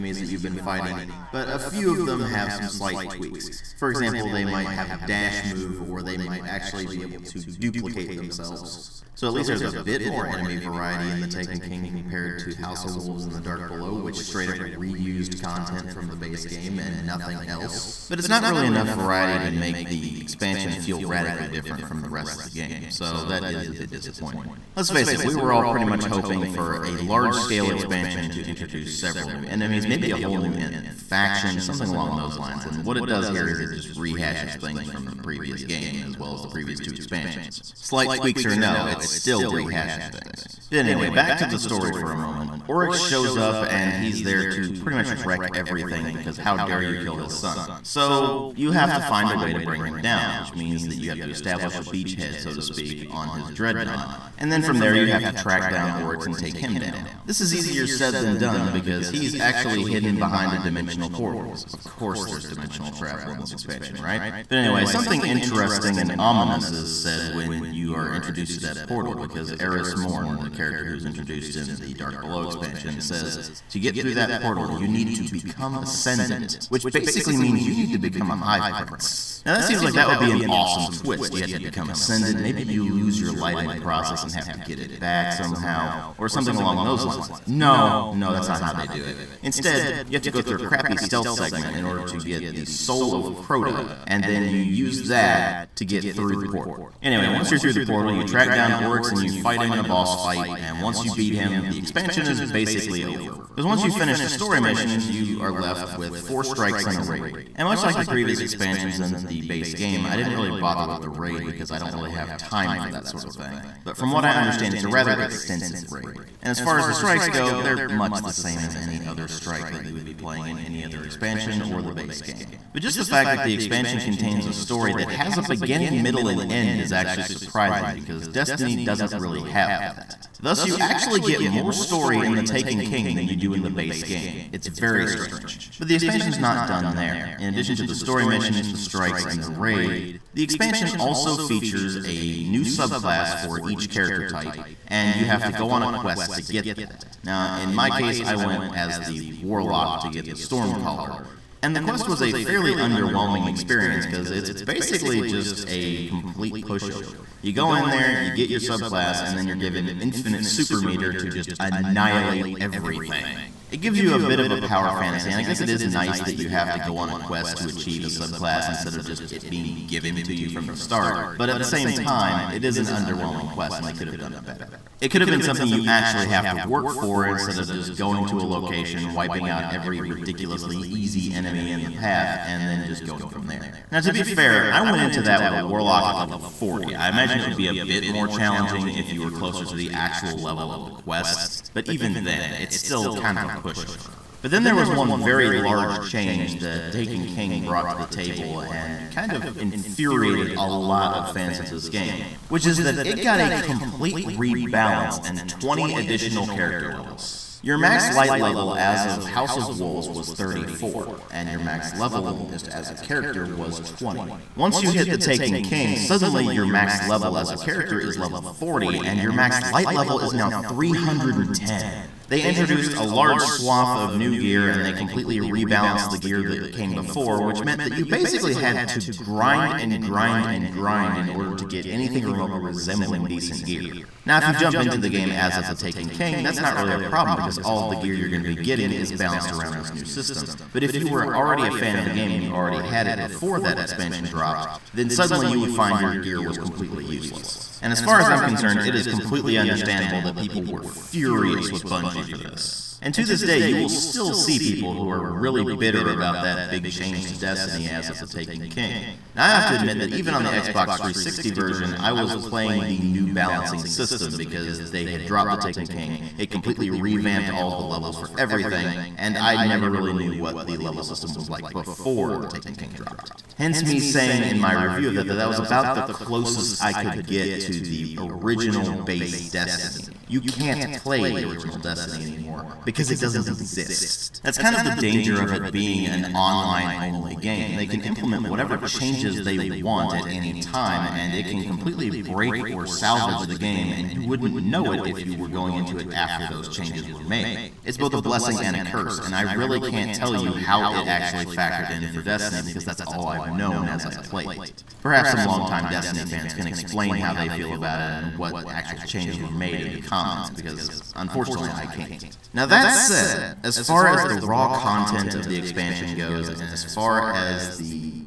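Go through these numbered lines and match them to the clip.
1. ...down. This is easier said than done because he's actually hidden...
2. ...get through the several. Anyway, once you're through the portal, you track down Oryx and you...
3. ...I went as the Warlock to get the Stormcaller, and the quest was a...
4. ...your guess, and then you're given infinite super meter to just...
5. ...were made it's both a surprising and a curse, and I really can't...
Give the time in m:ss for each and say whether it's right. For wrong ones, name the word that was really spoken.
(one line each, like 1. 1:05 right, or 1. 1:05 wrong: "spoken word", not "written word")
1. 0:56 right
2. 1:35 wrong: "portal", not "several"
3. 2:28 right
4. 2:38 wrong: "subclass", not "guess"
5. 4:57 wrong: "blessing", not "surprising".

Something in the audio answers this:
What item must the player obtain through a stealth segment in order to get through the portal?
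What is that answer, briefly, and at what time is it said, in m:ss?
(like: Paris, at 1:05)
Soul of Crota, at 1:32.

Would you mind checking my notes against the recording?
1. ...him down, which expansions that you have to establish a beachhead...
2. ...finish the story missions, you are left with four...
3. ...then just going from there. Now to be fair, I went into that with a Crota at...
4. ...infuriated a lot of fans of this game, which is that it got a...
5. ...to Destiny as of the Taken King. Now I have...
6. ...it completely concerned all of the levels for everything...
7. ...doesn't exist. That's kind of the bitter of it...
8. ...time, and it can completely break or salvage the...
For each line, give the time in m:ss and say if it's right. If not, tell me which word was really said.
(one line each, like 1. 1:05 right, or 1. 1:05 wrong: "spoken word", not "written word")
1. 0:49 wrong: "means", not "expansions"
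2. 1:43 right
3. 3:02 wrong: "Warlock", not "Crota"
4. 3:19 right
5. 4:17 right
6. 4:26 wrong: "revamped", not "concerned"
7. 4:43 wrong: "danger", not "bitter"
8. 4:50 right.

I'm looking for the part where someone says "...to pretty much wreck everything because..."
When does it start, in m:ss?
0:44.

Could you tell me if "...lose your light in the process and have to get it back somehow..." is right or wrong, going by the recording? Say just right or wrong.
right.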